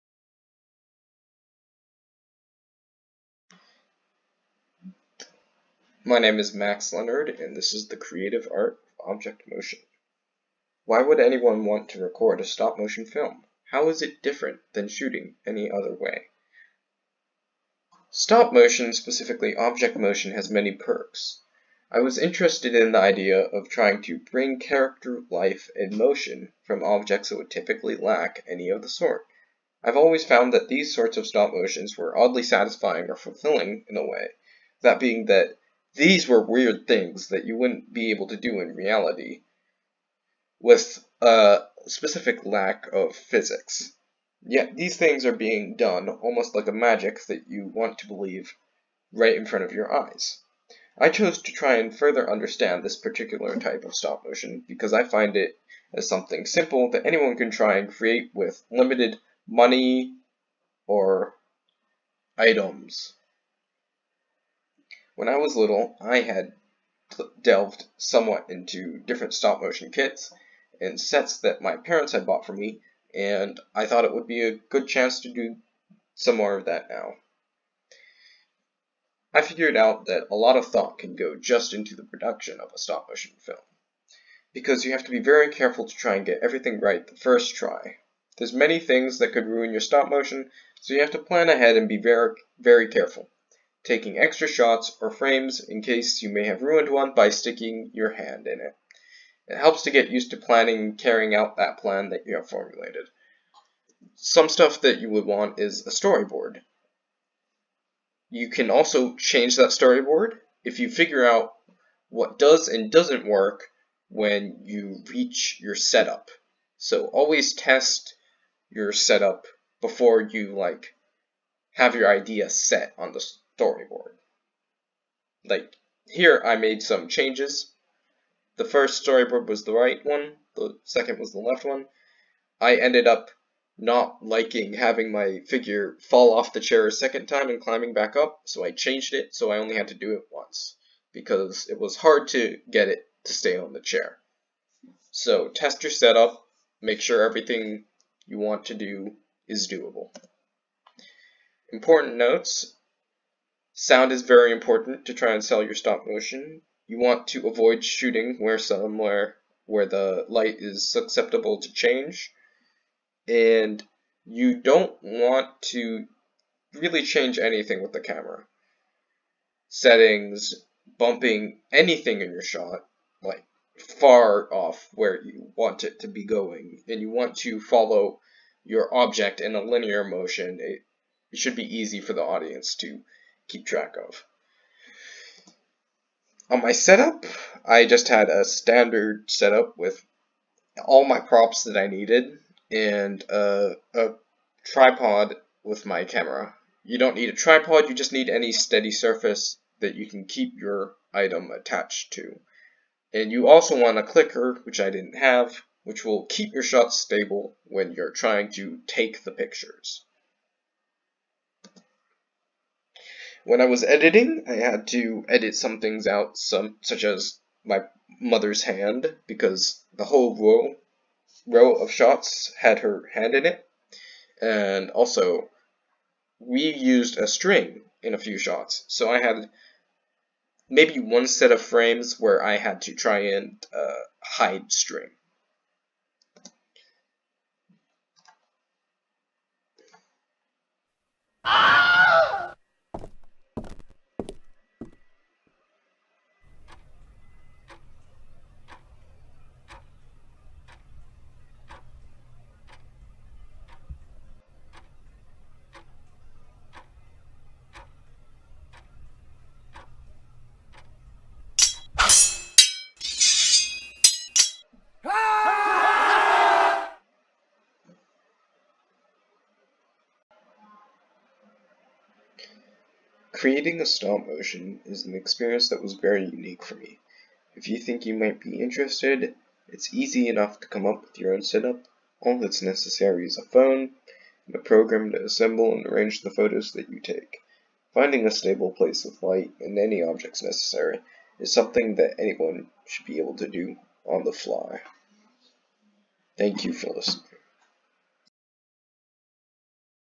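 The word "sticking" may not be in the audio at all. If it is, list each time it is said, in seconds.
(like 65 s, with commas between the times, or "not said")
97 s.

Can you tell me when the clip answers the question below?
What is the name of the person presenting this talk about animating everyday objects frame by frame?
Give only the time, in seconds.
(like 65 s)
6 s.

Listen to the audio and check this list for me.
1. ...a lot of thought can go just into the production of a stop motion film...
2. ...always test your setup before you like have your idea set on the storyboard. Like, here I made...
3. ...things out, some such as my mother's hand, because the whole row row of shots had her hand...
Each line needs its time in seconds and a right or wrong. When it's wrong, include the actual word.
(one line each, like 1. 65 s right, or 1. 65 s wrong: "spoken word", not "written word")
1. 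80 s right
2. 117 s right
3. 215 s right.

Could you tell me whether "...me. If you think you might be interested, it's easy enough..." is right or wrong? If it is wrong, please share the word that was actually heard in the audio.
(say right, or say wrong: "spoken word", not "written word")
right.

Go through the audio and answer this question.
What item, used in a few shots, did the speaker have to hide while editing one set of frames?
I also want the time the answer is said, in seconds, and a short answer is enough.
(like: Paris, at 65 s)
a string, at 227 s.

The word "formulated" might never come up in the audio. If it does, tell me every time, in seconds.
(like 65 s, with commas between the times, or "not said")
102 s.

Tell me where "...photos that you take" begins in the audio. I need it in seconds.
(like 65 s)
286 s.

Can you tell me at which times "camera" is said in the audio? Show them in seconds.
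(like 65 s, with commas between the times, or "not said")
168 s, 196 s.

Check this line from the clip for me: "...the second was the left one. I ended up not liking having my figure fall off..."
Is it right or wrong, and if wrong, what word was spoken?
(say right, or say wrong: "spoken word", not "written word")
right.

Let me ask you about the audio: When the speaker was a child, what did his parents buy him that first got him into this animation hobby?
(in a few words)
stop motion kits.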